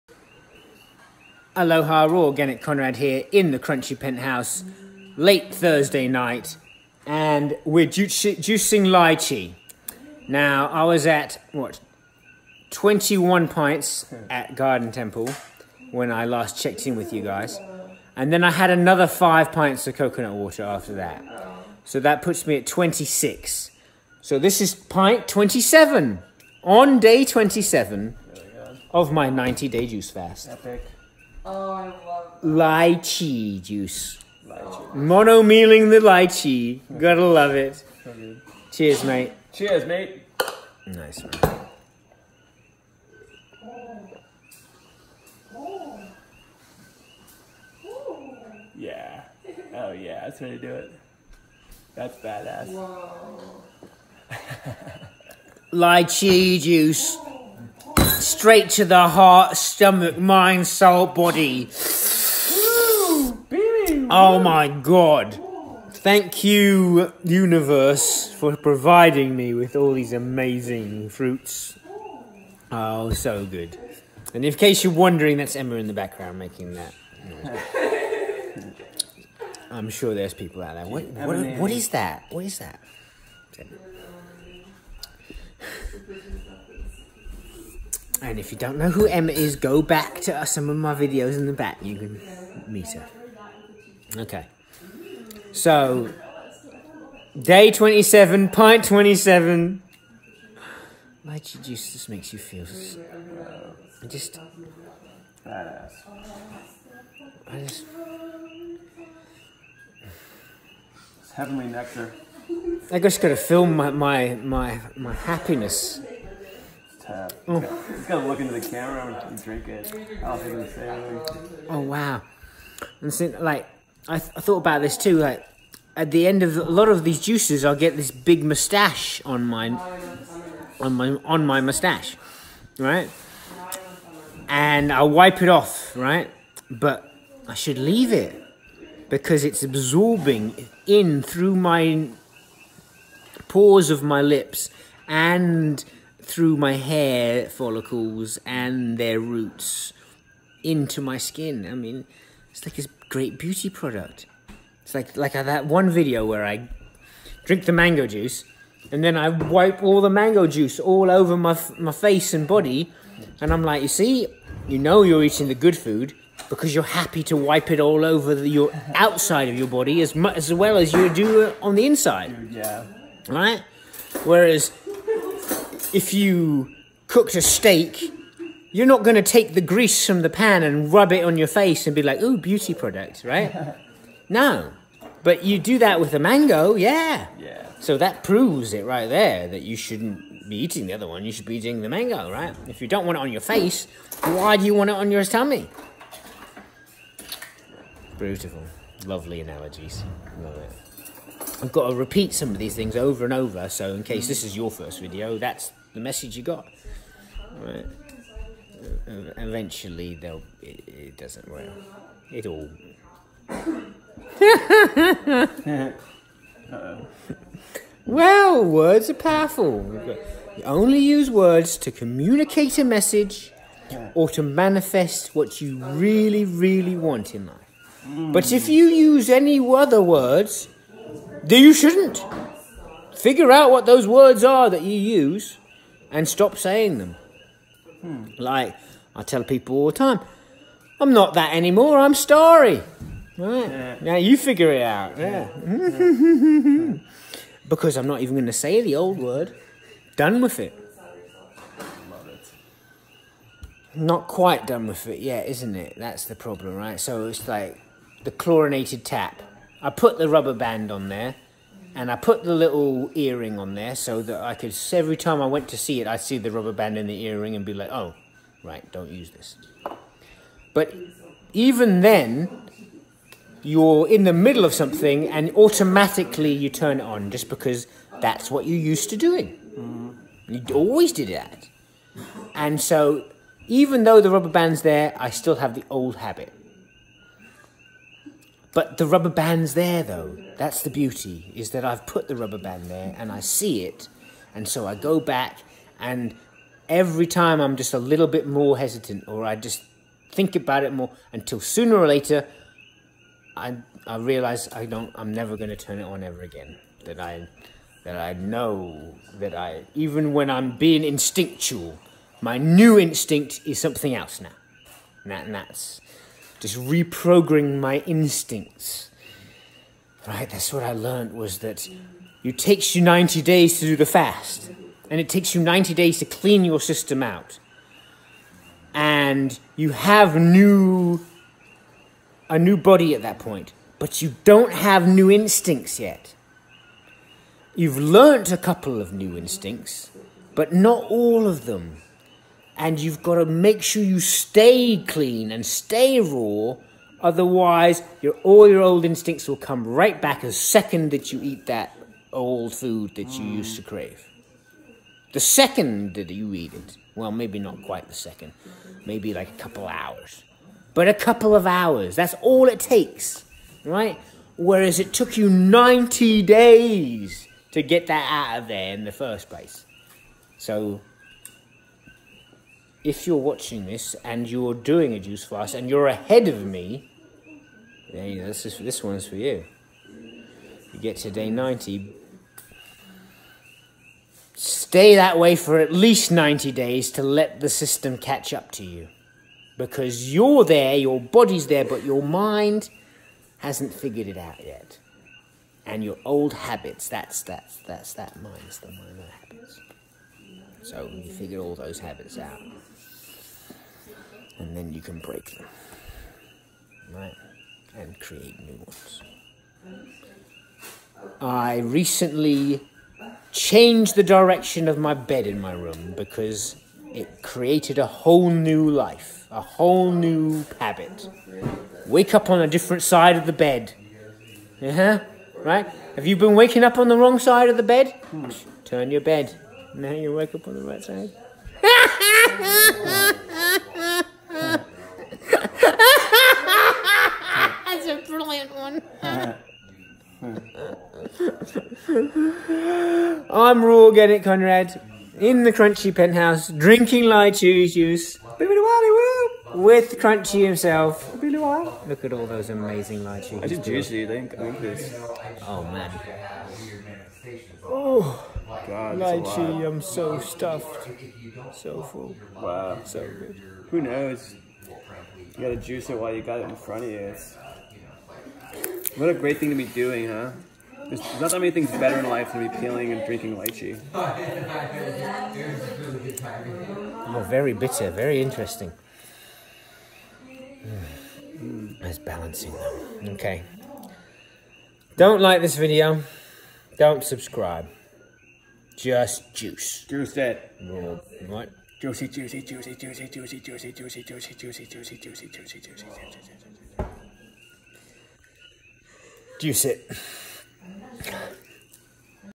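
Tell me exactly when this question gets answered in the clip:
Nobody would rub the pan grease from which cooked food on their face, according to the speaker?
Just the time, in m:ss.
2:57.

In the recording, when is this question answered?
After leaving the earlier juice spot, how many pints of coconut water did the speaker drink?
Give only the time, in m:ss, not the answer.
0:19.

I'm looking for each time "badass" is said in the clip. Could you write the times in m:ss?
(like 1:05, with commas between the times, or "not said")
0:52, 1:45.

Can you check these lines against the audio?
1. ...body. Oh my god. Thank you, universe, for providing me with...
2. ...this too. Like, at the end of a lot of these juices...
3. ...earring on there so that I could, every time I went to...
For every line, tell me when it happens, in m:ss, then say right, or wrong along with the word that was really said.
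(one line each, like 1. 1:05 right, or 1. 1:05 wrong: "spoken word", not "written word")
1. 1:01 right
2. 2:04 right
3. 4:23 right.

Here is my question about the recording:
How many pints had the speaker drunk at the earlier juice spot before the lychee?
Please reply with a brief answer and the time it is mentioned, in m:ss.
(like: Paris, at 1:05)
21, at 0:12.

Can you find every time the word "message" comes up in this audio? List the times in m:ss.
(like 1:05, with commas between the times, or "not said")
3:25, 3:42.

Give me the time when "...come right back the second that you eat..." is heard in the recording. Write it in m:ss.
5:49.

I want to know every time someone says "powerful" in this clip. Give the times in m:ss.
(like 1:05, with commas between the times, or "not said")
3:39.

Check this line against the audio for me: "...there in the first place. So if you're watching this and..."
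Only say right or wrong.
right.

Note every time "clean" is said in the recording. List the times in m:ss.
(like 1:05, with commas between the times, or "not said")
5:26, 5:45.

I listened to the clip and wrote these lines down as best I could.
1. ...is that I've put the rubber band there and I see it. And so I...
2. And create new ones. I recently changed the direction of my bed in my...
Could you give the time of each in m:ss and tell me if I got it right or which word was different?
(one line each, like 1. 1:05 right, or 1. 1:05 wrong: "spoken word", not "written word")
1. 4:51 right
2. 6:47 right.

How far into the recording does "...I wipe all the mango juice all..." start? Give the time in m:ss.
2:39.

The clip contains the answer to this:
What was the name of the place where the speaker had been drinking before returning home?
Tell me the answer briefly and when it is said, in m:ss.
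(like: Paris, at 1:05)
Garden Temple, at 0:14.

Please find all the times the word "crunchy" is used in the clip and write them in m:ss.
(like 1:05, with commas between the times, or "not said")
0:03, 7:25, 7:30.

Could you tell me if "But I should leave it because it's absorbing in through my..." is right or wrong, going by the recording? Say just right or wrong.
right.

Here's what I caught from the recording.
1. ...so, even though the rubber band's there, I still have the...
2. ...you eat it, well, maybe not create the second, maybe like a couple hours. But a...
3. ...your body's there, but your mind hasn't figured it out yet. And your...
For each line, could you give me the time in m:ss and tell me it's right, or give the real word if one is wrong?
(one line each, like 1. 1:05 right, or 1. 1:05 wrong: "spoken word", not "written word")
1. 4:42 right
2. 5:56 wrong: "quite", not "create"
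3. 6:30 right.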